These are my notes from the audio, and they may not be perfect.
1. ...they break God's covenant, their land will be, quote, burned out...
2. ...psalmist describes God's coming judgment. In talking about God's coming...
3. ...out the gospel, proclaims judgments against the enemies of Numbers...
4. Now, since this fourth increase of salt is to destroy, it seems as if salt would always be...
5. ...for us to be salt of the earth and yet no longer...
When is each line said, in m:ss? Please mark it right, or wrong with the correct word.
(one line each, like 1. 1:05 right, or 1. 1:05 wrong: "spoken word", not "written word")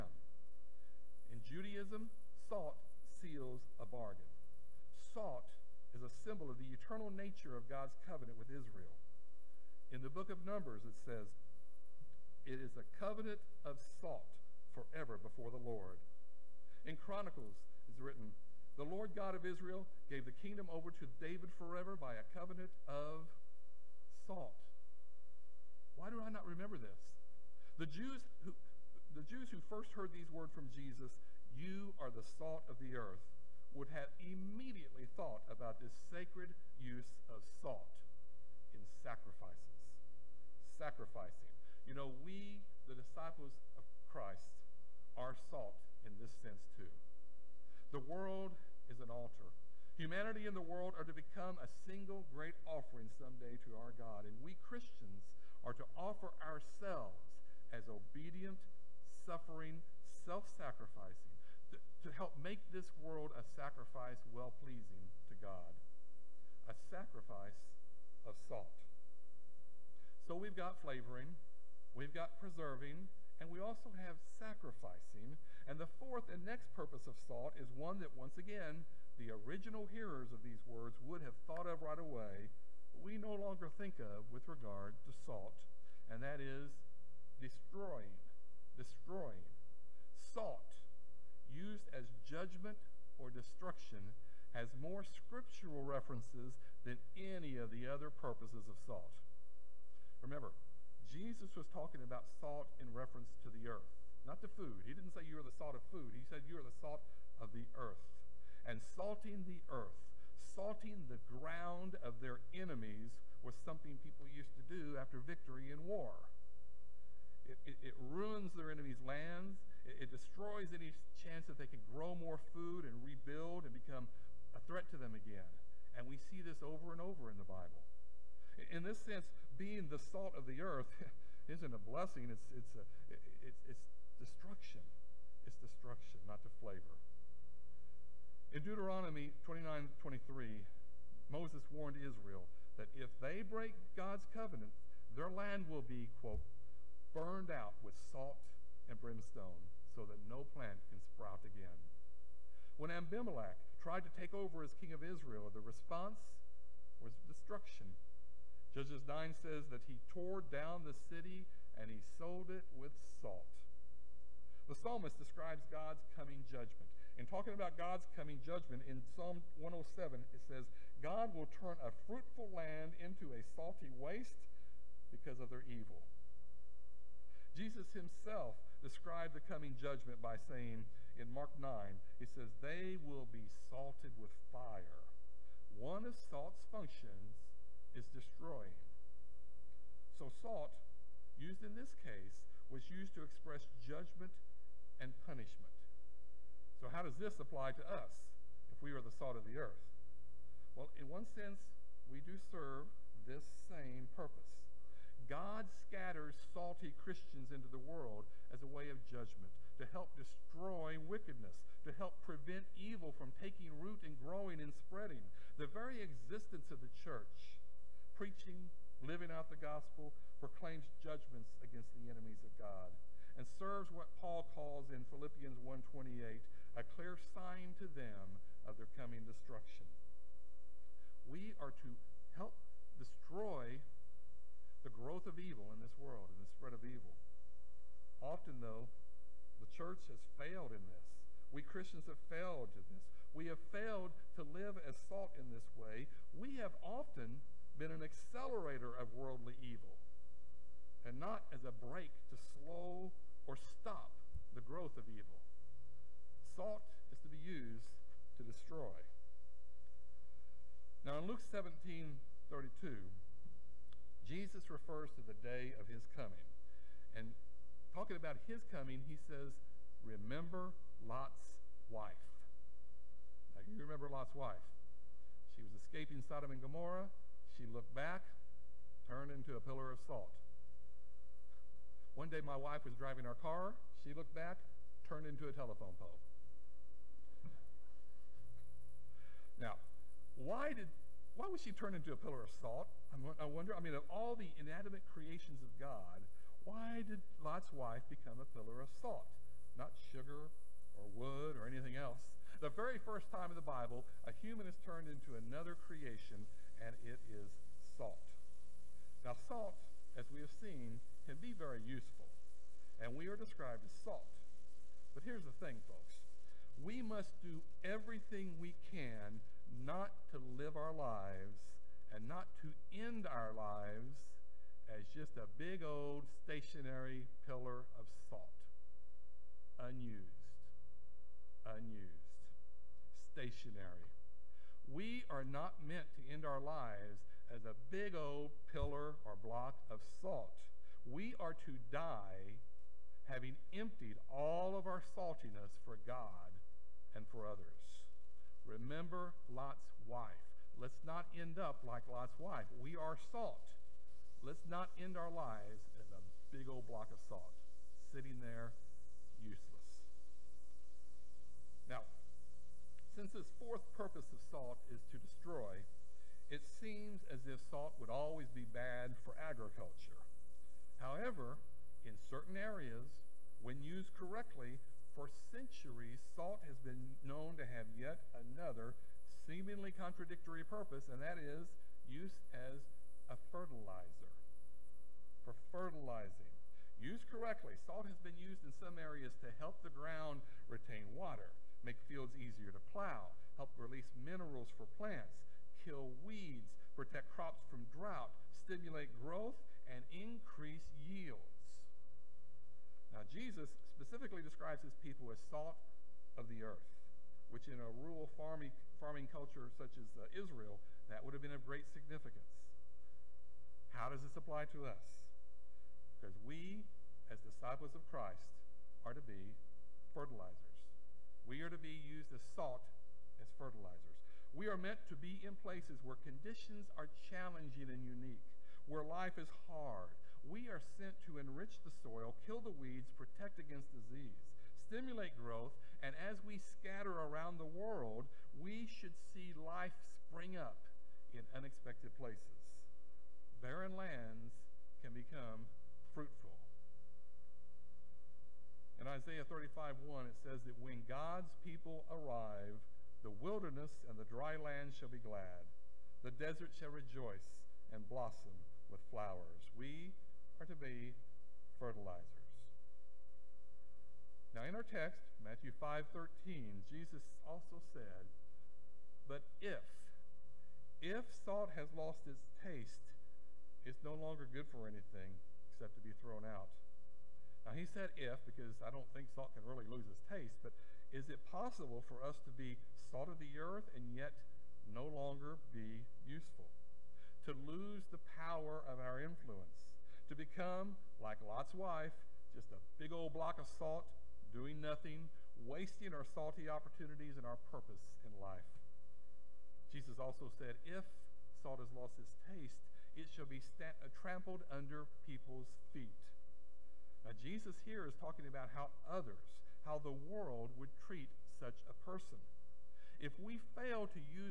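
1. 2:23 right
2. 2:44 right
3. 3:39 wrong: "God", not "Numbers"
4. 6:01 wrong: "purpose", not "increase"
5. 8:02 right.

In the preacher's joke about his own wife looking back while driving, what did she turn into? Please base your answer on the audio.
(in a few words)
a telephone pole.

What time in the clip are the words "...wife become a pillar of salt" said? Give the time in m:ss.
4:57.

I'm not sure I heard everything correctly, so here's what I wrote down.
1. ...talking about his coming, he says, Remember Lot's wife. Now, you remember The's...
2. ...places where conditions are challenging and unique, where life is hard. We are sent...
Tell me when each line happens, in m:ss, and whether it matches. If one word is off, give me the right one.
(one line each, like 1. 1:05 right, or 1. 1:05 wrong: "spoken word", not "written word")
1. 4:27 wrong: "Lot", not "The"
2. 7:05 right.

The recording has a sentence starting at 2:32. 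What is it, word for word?
When Abimelech tried to take over as king of Israel, the response was destruction.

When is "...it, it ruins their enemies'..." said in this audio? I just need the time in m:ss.
1:57.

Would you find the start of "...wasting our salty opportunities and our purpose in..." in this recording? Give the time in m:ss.
8:15.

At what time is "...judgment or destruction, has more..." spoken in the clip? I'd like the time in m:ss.
1:32.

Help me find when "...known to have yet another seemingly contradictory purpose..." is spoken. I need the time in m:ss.
6:17.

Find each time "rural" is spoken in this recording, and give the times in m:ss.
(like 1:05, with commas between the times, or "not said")
6:47.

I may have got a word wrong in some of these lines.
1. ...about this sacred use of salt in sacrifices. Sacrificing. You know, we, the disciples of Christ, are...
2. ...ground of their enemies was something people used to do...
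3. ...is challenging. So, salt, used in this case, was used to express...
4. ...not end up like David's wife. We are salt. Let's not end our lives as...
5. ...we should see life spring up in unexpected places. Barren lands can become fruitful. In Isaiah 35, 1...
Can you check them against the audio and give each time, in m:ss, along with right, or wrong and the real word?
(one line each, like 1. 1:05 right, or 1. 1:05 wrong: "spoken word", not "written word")
1. 0:35 right
2. 1:51 right
3. 3:07 wrong: "destroying", not "challenging"
4. 5:51 wrong: "Lot", not "David"
5. 7:18 right.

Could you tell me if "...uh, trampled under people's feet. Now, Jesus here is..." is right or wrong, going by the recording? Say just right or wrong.
right.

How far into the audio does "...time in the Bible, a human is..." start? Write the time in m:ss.
5:03.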